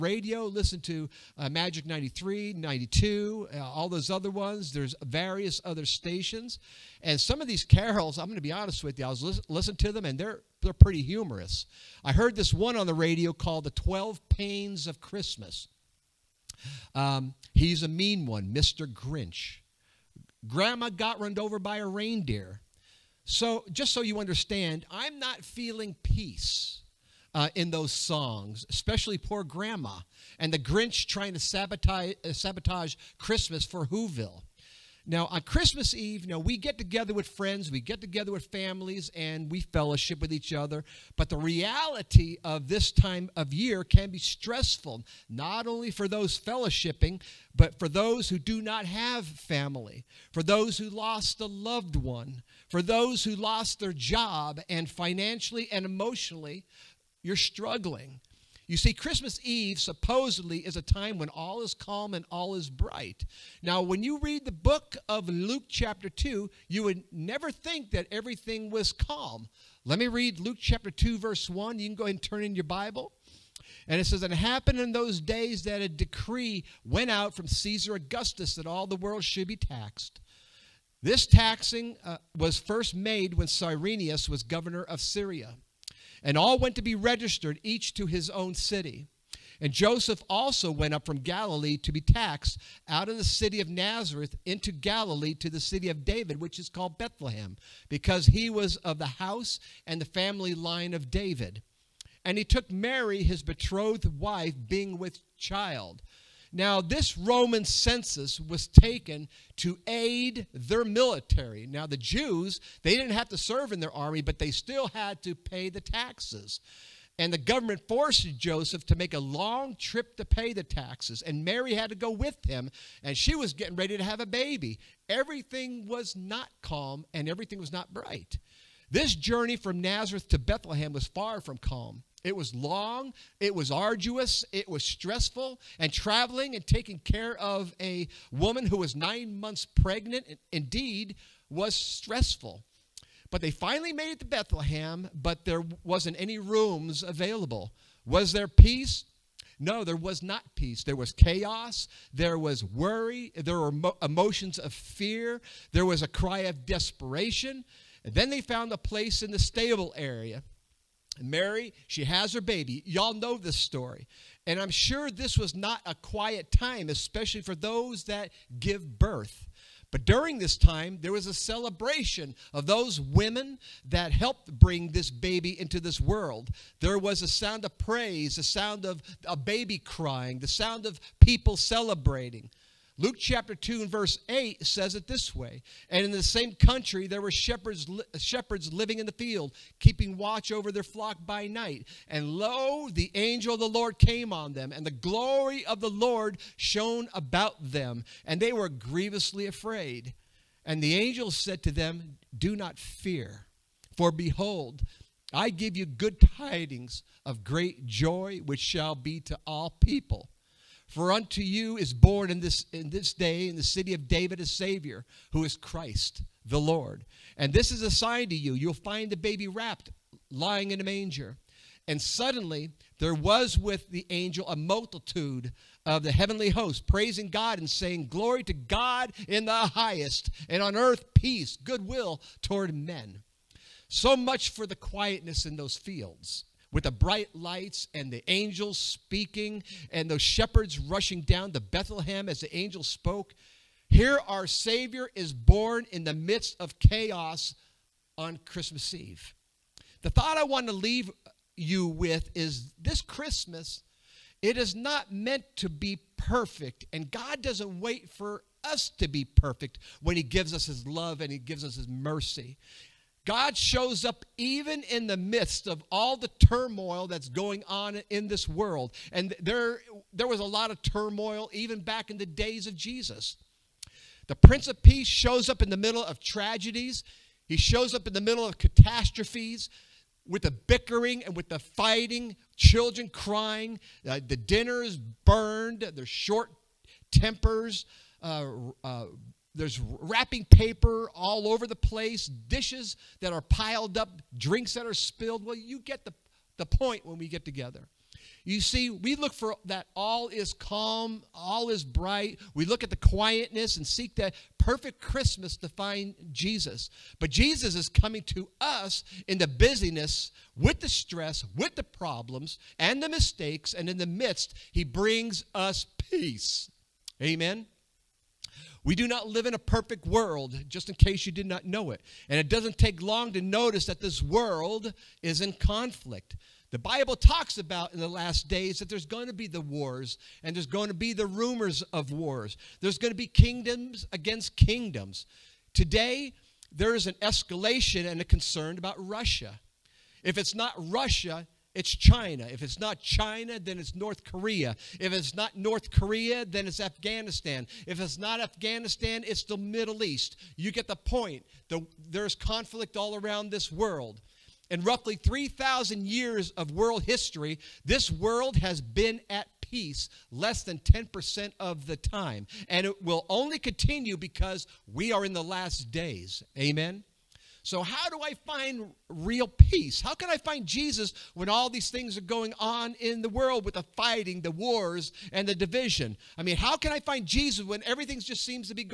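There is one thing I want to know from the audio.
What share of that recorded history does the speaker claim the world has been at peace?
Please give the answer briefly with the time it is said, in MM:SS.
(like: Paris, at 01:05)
Less than 10%, at 06:00.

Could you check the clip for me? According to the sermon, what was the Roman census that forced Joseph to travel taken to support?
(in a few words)
Their military.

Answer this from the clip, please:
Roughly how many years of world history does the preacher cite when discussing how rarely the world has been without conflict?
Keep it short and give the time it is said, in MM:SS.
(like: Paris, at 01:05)
3,000, at 05:55.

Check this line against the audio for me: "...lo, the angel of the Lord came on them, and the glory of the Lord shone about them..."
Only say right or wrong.
right.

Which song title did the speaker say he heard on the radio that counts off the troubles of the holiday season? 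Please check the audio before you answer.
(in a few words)
The 12 Pains of Christmas.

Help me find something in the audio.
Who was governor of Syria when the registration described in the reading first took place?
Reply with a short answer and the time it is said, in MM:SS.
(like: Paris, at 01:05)
Cyrenius, at 01:23.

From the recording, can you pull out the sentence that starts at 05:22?
And it doesn't take long to notice that this world is in conflict.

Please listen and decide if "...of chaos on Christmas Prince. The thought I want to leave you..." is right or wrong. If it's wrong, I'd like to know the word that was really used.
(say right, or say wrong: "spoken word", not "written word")
wrong: "Eve", not "Prince".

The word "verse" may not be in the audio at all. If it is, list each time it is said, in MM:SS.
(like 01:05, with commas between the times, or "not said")
01:11, 03:03.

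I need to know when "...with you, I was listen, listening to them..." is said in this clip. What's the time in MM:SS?
00:08.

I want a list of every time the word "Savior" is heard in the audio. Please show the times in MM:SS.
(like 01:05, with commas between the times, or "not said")
03:34, 04:04.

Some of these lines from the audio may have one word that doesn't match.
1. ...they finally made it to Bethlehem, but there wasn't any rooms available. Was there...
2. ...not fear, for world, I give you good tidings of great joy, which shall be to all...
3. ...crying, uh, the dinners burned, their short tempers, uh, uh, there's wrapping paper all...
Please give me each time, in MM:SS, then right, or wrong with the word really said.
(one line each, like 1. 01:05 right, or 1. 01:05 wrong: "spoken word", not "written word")
1. 02:23 right
2. 03:22 wrong: "behold", not "world"
3. 04:43 right.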